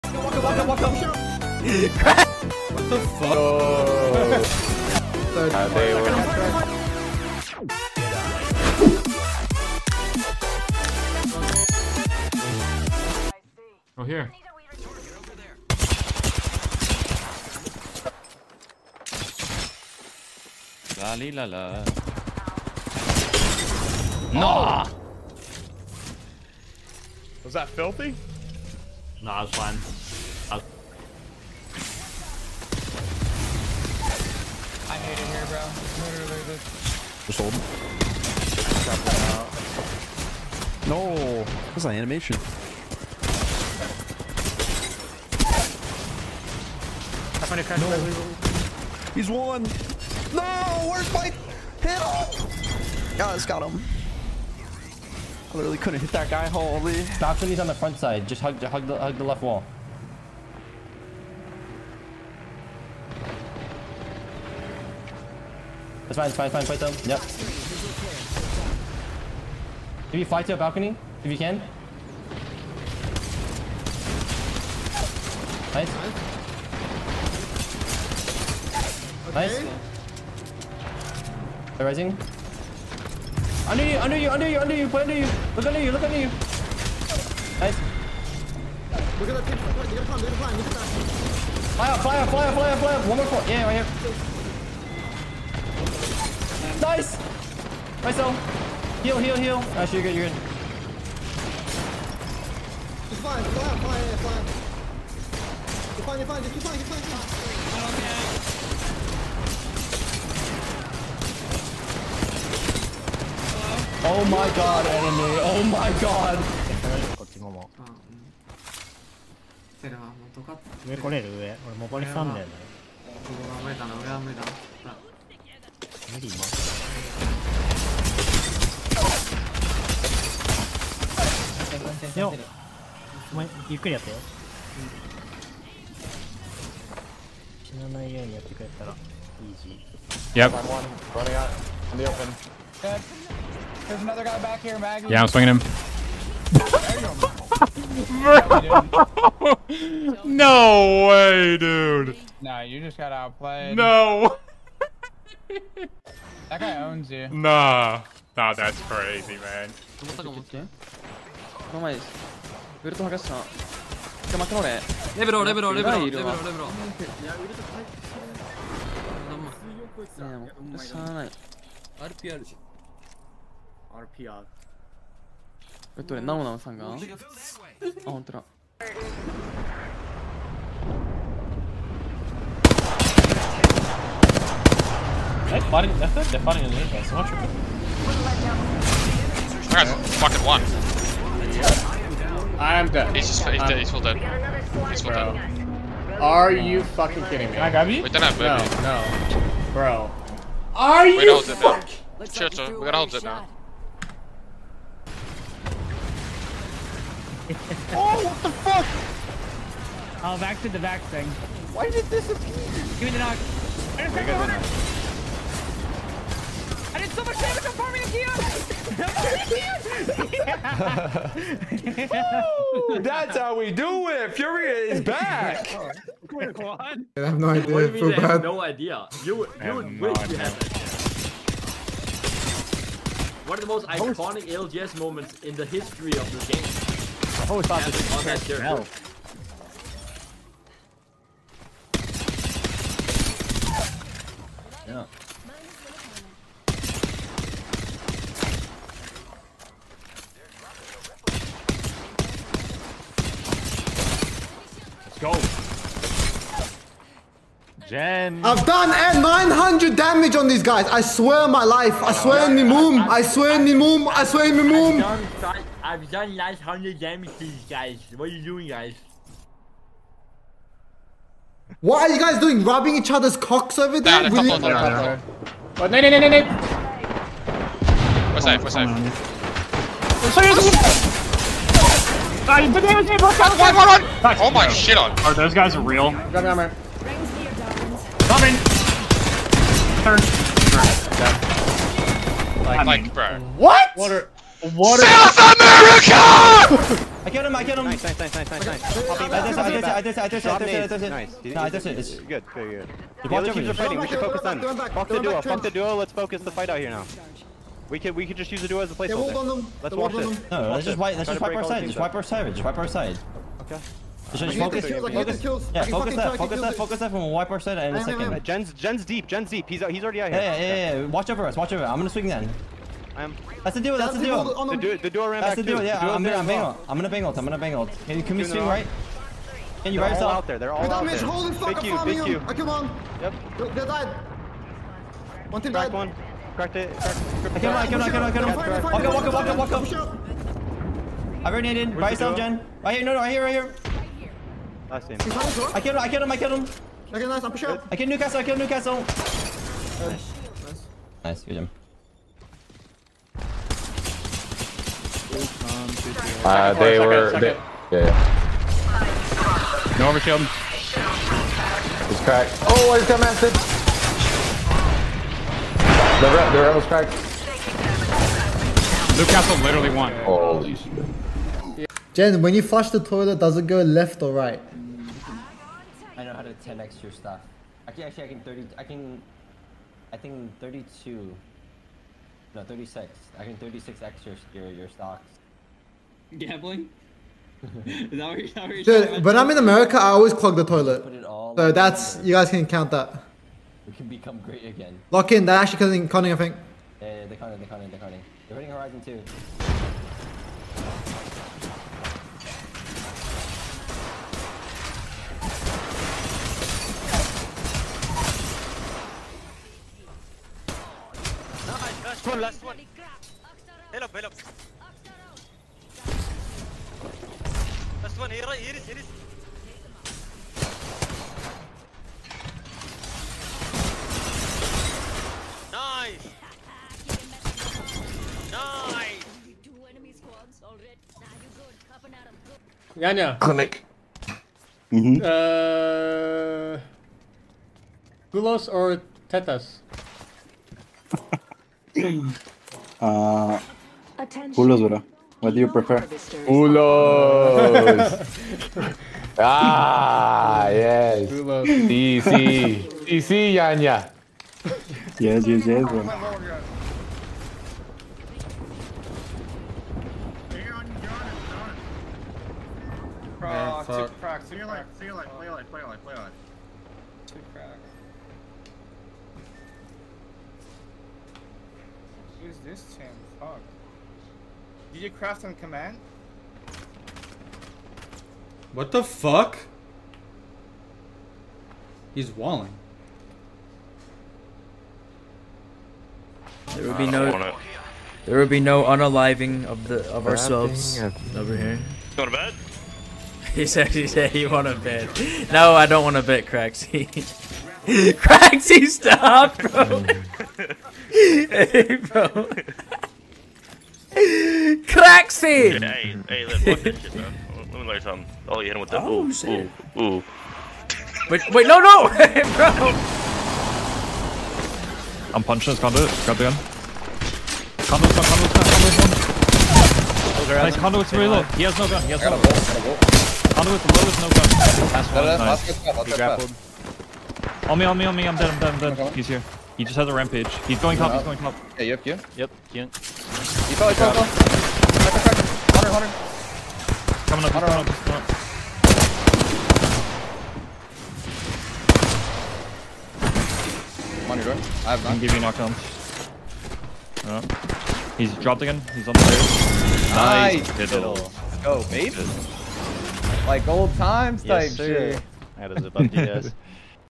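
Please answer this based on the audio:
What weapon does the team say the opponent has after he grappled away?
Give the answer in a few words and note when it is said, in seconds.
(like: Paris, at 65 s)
Rampage, at 530 s.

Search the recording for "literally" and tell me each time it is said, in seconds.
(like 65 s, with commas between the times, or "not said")
36 s, 55 s, 369 s.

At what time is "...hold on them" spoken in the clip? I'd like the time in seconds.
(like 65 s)
309 s.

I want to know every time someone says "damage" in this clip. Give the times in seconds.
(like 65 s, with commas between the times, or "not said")
217 s, 259 s, 266 s.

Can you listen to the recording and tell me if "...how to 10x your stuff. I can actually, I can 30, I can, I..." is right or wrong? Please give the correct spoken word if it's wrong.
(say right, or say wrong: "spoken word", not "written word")
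right.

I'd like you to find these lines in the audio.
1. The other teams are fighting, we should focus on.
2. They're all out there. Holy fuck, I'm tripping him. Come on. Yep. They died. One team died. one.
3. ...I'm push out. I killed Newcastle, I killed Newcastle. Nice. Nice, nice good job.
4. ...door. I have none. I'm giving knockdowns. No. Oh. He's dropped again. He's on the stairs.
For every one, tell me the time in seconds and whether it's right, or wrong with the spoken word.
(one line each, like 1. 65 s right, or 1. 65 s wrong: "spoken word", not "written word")
1. 303 s right
2. 330 s wrong: "farming", not "tripping"
3. 347 s right
4. 544 s right.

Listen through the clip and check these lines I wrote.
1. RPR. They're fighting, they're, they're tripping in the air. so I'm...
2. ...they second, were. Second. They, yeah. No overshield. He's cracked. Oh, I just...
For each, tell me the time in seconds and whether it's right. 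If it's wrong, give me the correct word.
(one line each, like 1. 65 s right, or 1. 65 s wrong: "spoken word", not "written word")
1. 178 s wrong: "fighting", not "tripping"
2. 356 s right.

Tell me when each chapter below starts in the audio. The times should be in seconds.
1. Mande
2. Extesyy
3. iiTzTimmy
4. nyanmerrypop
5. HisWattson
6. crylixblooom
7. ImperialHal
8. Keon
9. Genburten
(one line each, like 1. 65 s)
1. 13 s
2. 30 s
3. 58 s
4. 118 s
5. 142 s
6. 162 s
7. 181 s
8. 208 s
9. 231 s.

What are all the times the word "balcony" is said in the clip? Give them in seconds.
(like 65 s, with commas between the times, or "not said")
70 s.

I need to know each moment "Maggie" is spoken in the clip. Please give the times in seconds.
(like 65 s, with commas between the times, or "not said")
144 s.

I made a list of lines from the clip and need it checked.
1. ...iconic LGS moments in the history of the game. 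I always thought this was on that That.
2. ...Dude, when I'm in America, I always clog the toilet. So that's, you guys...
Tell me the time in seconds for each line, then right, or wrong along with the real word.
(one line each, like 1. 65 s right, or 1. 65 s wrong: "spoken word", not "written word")
1. 233 s wrong: "Yeah", not "That"
2. 387 s right.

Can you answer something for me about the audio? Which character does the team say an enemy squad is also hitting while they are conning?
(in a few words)
Horizon.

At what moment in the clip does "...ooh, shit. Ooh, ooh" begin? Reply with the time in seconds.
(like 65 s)
509 s.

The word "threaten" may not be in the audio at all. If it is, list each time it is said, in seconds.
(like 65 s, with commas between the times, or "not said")
not said.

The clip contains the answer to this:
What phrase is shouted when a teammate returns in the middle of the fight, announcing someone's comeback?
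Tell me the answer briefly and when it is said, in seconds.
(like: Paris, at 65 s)
Fury is back, at 224 s.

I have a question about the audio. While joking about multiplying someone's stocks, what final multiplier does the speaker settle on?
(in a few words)
36x.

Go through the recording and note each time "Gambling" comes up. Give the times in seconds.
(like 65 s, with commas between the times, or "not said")
386 s.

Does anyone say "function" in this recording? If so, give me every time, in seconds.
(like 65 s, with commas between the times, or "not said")
not said.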